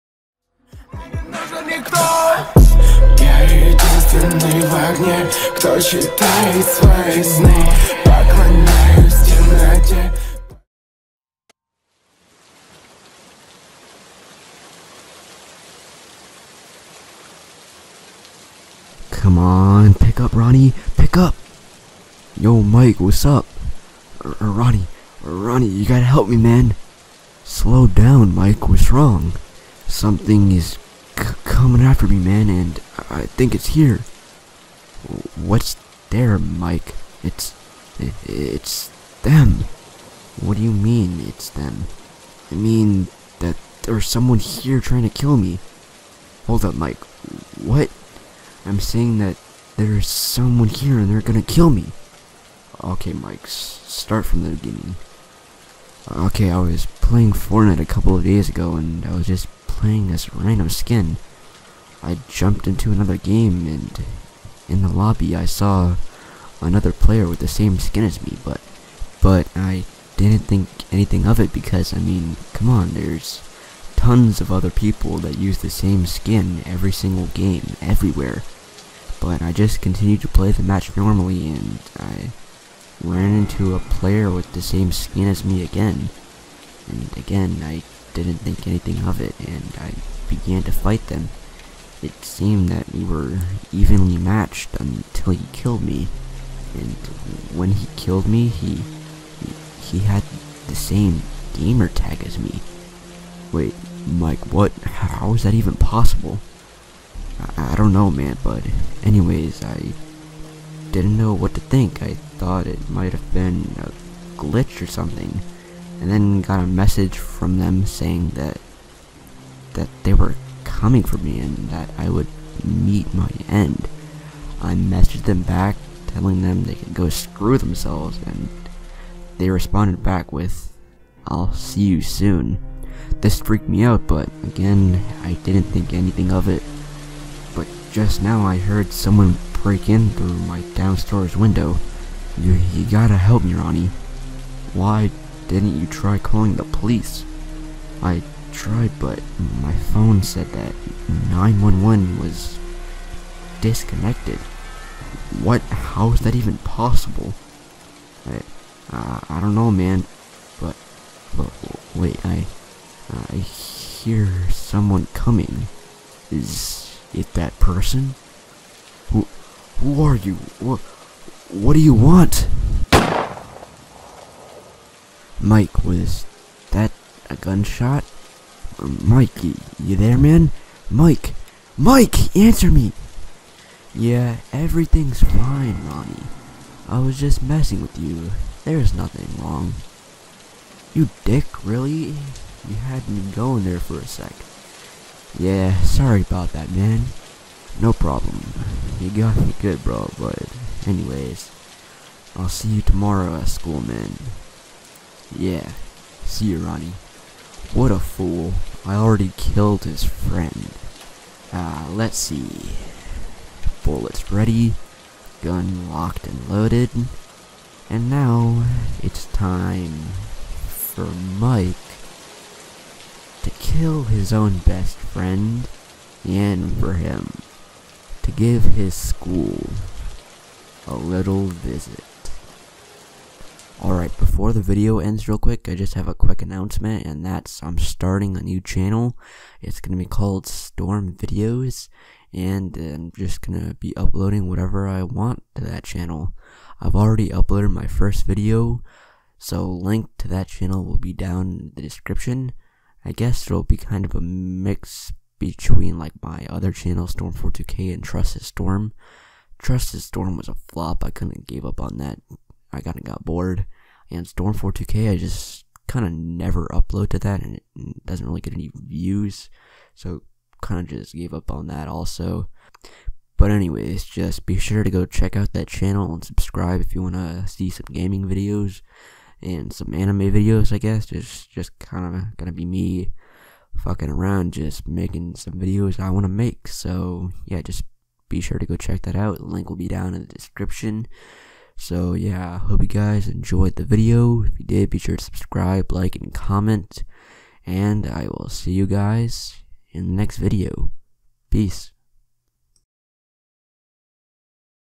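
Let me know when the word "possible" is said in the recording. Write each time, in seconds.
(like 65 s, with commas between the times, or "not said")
105 s, 156 s.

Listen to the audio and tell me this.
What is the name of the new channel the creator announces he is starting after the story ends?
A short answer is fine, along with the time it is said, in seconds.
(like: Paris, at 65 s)
Storm Videos, at 240 s.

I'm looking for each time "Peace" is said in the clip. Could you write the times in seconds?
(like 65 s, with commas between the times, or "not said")
301 s.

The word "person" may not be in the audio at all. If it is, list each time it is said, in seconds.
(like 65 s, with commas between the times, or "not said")
167 s.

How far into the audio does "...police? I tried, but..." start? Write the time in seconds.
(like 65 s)
146 s.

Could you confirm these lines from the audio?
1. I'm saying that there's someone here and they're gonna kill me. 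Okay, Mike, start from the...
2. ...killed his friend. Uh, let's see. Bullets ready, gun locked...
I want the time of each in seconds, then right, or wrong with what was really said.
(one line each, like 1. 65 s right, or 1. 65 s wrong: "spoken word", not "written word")
1. 48 s right
2. 209 s right.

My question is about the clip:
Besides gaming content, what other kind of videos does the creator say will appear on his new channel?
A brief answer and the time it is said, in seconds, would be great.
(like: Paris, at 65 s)
anime videos, at 279 s.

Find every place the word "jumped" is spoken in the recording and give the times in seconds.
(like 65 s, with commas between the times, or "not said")
62 s.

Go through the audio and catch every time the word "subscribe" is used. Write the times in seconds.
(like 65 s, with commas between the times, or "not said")
276 s, 295 s.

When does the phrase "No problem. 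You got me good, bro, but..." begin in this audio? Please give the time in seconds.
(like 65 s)
197 s.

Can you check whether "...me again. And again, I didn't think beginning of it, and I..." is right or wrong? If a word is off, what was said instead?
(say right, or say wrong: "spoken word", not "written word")
wrong: "anything", not "beginning".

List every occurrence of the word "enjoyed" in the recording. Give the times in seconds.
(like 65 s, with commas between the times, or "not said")
293 s.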